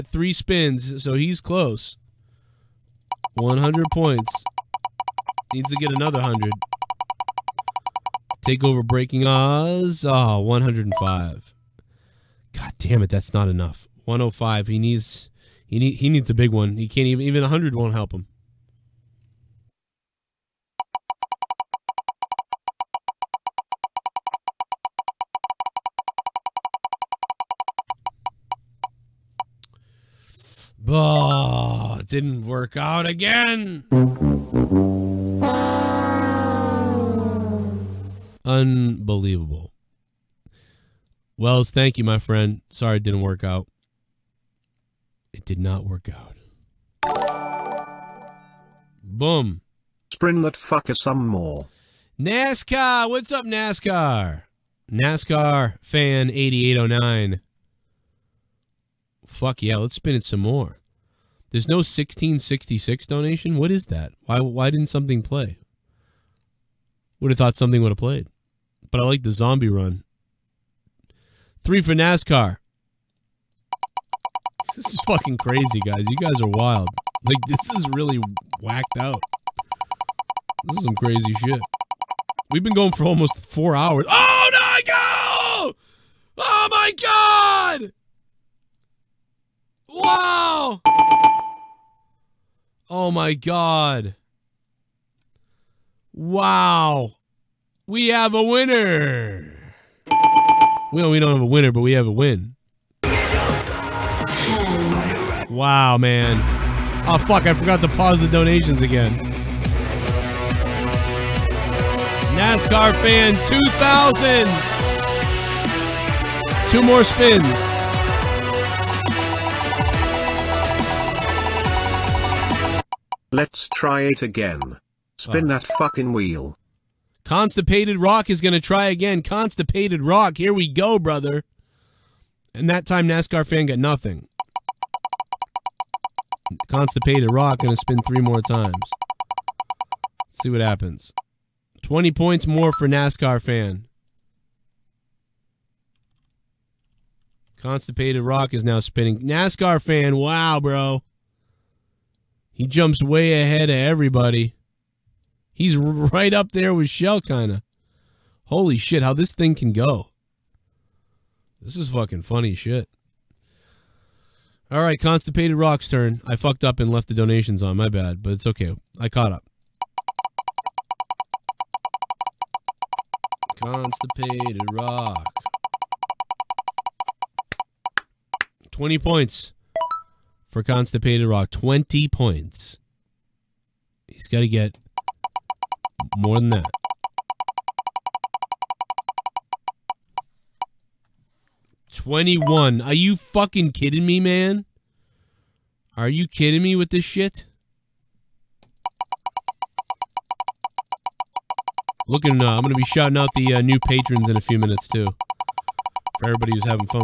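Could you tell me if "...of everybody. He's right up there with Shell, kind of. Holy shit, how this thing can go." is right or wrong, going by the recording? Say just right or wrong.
right.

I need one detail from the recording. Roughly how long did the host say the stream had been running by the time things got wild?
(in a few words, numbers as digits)
almost four hours.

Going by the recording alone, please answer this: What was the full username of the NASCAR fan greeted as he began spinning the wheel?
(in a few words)
NASCAR fan 8809.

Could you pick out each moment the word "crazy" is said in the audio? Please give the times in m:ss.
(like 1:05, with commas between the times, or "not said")
1:15, 1:20.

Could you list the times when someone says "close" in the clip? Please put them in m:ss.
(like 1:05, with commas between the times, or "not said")
0:01.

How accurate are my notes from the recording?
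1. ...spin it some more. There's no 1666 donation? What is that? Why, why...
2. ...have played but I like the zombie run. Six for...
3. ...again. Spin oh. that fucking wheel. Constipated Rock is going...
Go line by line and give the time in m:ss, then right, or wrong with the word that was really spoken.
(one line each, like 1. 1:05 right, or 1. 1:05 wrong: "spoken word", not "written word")
1. 0:59 right
2. 1:07 wrong: "Three", not "Six"
3. 2:04 right.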